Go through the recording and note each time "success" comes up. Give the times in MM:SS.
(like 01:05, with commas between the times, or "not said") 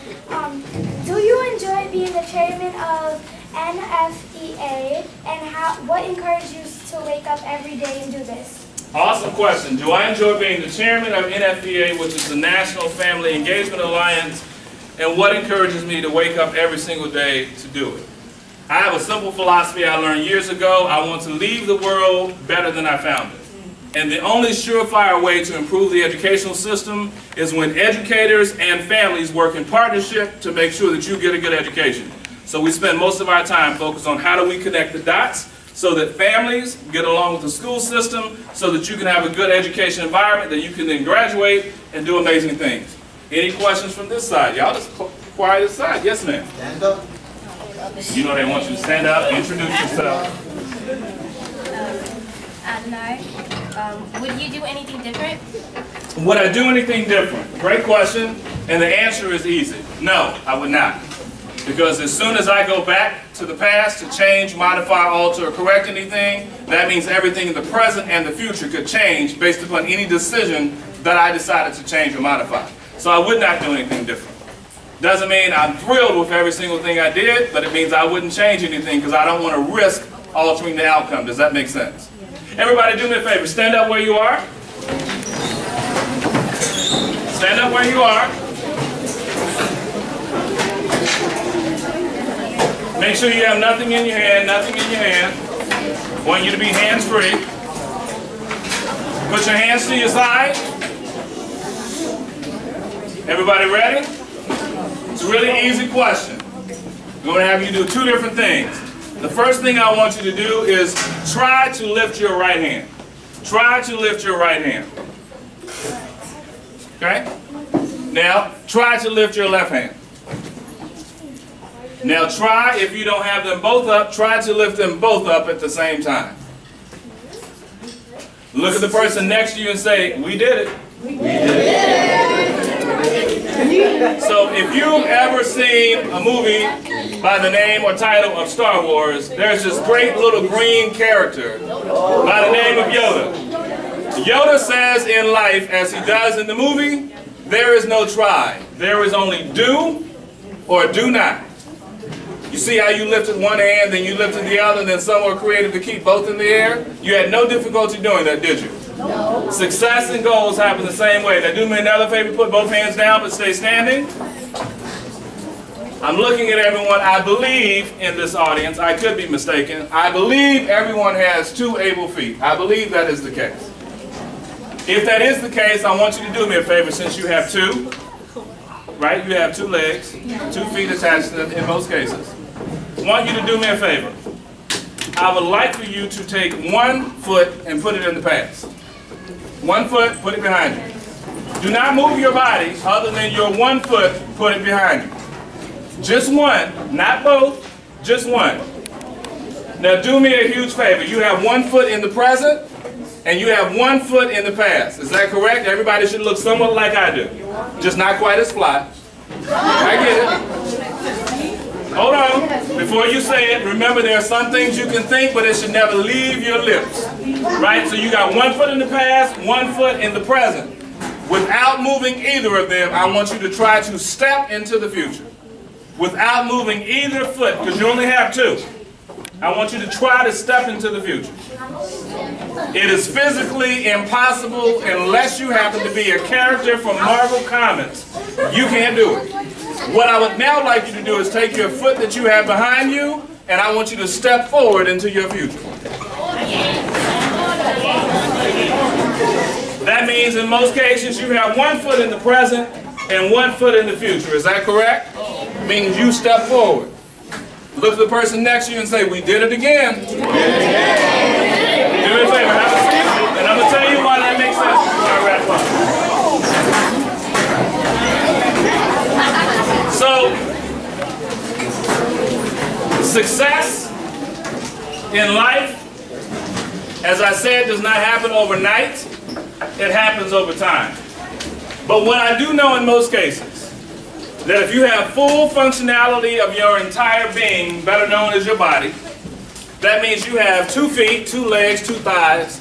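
02:39, 04:33.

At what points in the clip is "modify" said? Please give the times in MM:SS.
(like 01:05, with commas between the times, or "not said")
01:04, 01:12.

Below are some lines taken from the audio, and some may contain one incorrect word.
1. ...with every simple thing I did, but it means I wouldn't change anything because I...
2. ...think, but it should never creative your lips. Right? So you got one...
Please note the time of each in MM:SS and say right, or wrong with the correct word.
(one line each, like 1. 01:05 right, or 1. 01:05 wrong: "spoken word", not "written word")
1. 01:16 wrong: "single", not "simple"
2. 03:35 wrong: "leave", not "creative".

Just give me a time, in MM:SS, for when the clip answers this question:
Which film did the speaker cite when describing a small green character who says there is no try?
02:18.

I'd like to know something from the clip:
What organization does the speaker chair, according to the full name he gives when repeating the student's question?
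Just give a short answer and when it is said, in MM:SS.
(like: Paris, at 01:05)
National Family Engagement Alliance, at 00:12.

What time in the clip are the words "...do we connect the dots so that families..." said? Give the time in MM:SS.
00:34.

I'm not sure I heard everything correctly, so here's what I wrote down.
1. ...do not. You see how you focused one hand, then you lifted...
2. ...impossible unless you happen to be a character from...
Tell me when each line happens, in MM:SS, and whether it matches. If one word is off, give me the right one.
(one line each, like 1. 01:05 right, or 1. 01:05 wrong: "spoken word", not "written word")
1. 02:30 wrong: "lifted", not "focused"
2. 03:53 right.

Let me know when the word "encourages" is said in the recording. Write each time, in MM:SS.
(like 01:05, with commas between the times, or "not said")
00:06, 00:15.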